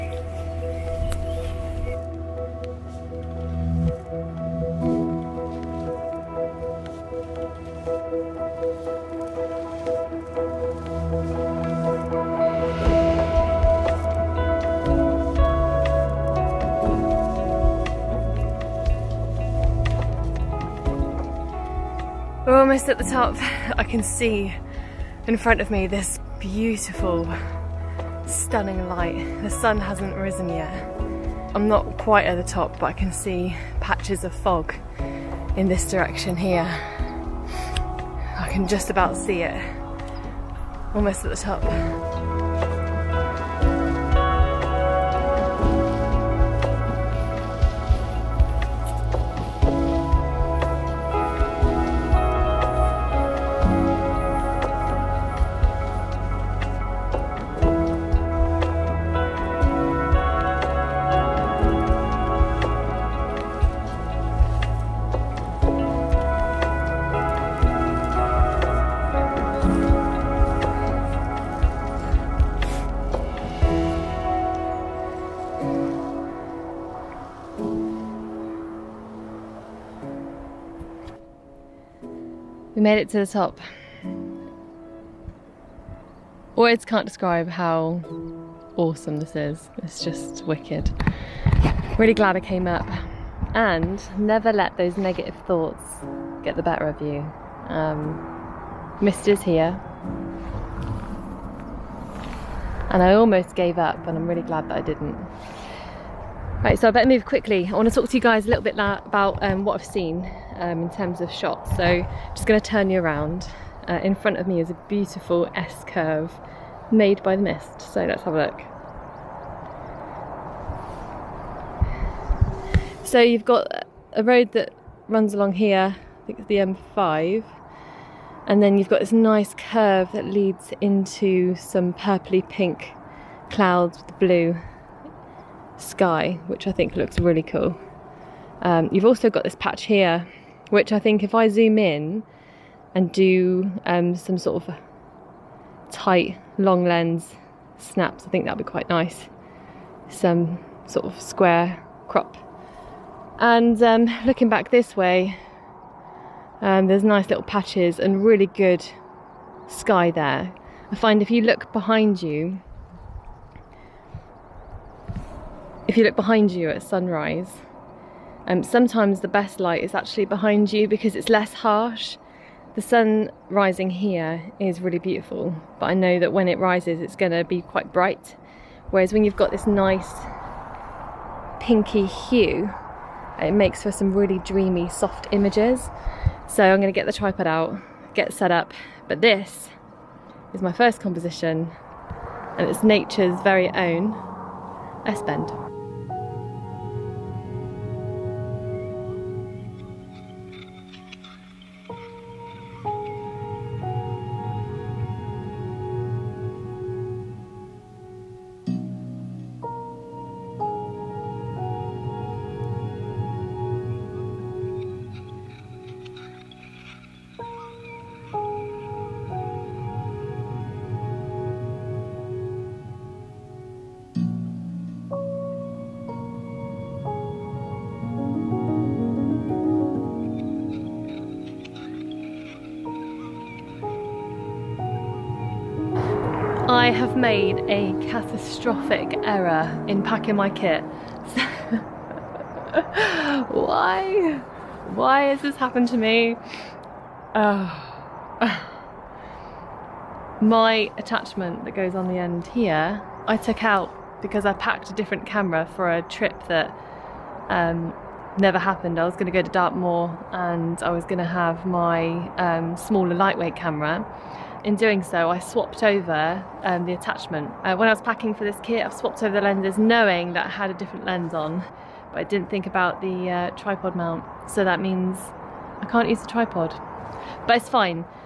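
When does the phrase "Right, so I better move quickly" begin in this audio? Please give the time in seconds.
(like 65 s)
106 s.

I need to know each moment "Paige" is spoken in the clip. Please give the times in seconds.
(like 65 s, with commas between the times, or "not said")
not said.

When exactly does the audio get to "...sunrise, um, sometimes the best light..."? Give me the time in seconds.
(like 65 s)
166 s.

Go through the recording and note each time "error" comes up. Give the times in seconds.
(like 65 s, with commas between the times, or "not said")
239 s.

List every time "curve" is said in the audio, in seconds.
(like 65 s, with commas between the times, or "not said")
115 s, 129 s.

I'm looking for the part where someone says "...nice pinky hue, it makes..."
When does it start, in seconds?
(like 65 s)
179 s.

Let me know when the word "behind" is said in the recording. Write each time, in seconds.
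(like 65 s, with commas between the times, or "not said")
161 s, 166 s, 170 s.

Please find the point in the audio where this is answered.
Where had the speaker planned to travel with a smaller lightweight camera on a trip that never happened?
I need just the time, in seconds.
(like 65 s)
259 s.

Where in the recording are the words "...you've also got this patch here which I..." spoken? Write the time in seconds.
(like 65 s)
138 s.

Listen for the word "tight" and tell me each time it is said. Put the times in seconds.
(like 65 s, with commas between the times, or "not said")
145 s.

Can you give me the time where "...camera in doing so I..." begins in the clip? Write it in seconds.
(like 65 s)
263 s.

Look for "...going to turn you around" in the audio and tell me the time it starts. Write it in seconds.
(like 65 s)
112 s.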